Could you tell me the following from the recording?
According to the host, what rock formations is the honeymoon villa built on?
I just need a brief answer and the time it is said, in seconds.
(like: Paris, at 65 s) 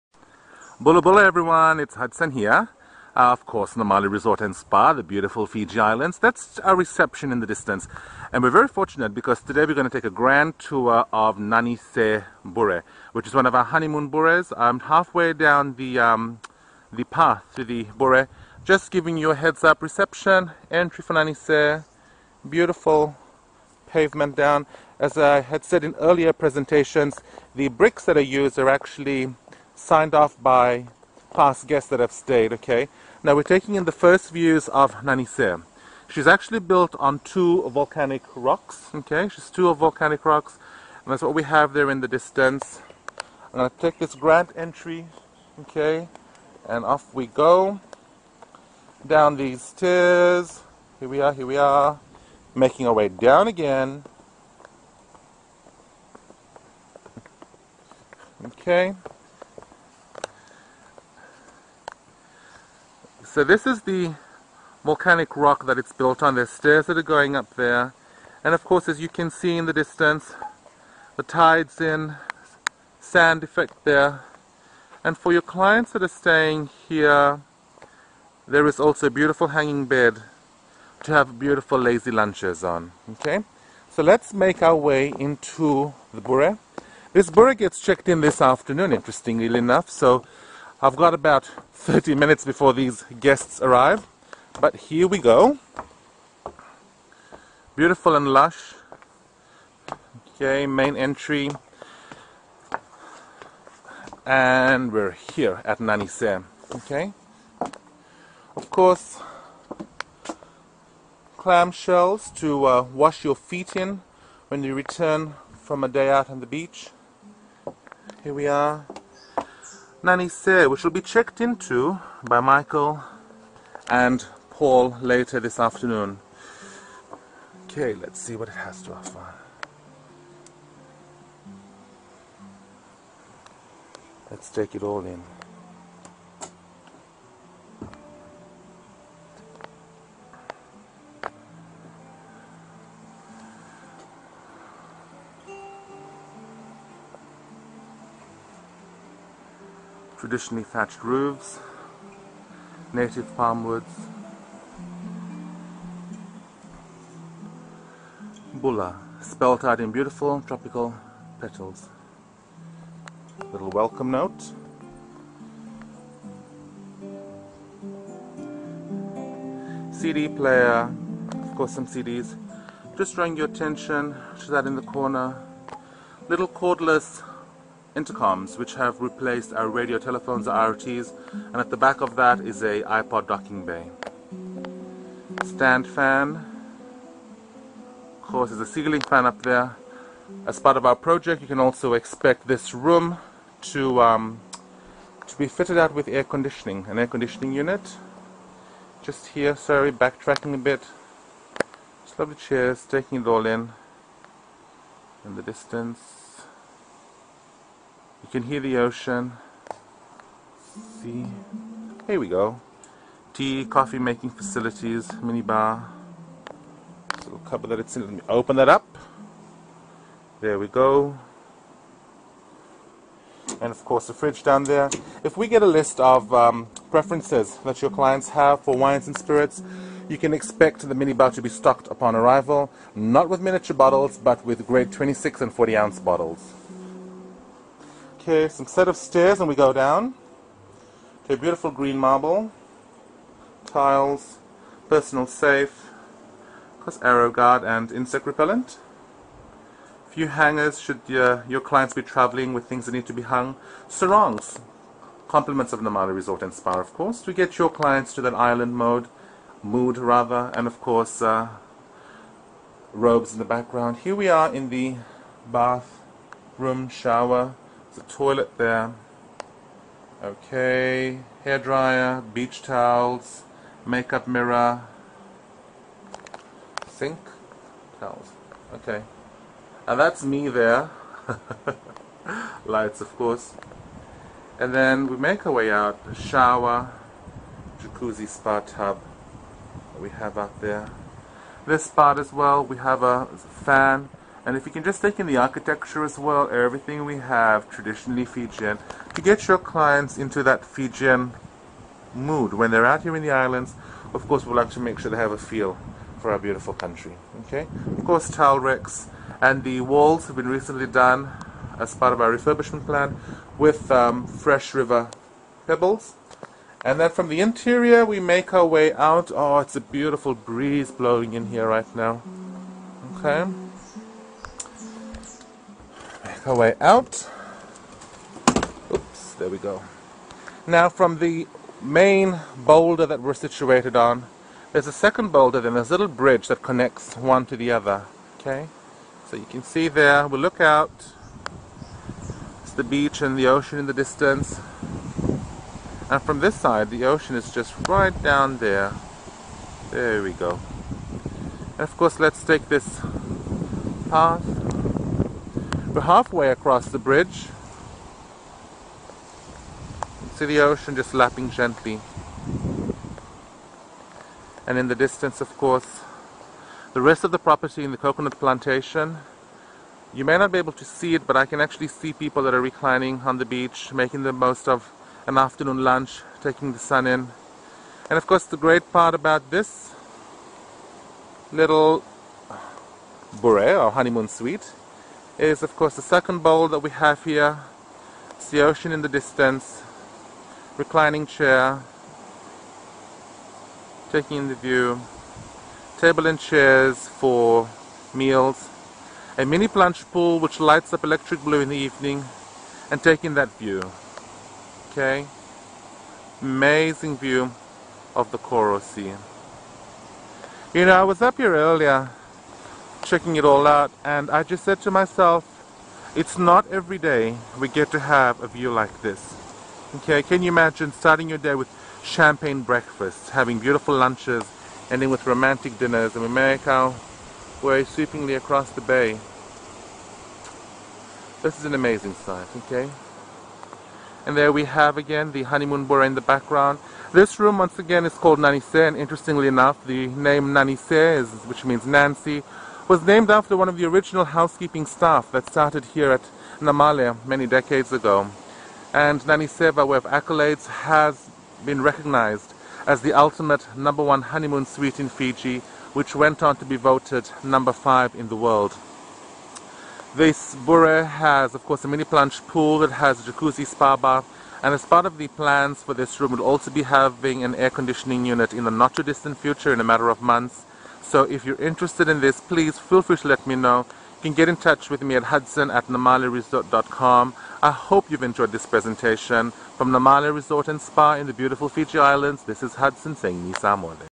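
two volcanic rocks, at 37 s.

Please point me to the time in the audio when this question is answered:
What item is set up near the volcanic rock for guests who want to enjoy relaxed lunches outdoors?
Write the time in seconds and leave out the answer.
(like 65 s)
79 s.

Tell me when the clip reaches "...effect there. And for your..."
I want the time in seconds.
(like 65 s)
73 s.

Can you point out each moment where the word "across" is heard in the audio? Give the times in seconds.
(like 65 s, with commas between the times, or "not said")
356 s, 428 s.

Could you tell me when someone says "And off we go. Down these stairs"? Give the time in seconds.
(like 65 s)
46 s.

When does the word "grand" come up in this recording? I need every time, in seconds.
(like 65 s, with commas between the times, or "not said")
10 s, 44 s.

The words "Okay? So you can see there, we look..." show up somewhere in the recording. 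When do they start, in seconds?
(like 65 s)
338 s.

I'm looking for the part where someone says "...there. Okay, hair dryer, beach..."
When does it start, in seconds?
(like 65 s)
268 s.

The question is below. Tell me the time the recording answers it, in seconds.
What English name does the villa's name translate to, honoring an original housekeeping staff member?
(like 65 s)
441 s.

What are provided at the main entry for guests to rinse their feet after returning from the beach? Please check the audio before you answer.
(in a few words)
clamshells.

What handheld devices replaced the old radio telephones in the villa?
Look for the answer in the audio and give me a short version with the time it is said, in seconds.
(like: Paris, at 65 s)
cordless intercoms, at 176 s.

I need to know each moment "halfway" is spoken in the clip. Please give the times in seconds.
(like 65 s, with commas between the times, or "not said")
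14 s, 356 s.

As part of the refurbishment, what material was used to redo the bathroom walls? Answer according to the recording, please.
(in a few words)
fresh river pebbles.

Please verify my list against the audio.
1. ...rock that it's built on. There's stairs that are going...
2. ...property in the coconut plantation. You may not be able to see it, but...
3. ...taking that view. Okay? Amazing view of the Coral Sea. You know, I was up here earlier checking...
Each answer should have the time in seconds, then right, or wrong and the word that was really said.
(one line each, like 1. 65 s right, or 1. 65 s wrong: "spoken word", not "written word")
1. 65 s right
2. 367 s right
3. 403 s right.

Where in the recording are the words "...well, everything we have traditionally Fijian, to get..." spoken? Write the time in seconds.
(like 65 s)
296 s.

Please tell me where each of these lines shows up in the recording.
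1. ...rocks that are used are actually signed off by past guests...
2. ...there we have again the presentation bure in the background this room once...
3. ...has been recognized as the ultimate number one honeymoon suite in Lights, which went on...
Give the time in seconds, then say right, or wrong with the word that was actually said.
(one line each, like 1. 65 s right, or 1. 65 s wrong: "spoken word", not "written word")
1. 27 s wrong: "bricks", not "rocks"
2. 434 s wrong: "honeymoon", not "presentation"
3. 450 s wrong: "Fiji", not "Lights".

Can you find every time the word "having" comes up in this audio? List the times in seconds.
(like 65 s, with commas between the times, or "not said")
423 s, 466 s.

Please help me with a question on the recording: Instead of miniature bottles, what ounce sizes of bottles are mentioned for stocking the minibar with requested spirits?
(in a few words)
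26 and 40 ounce.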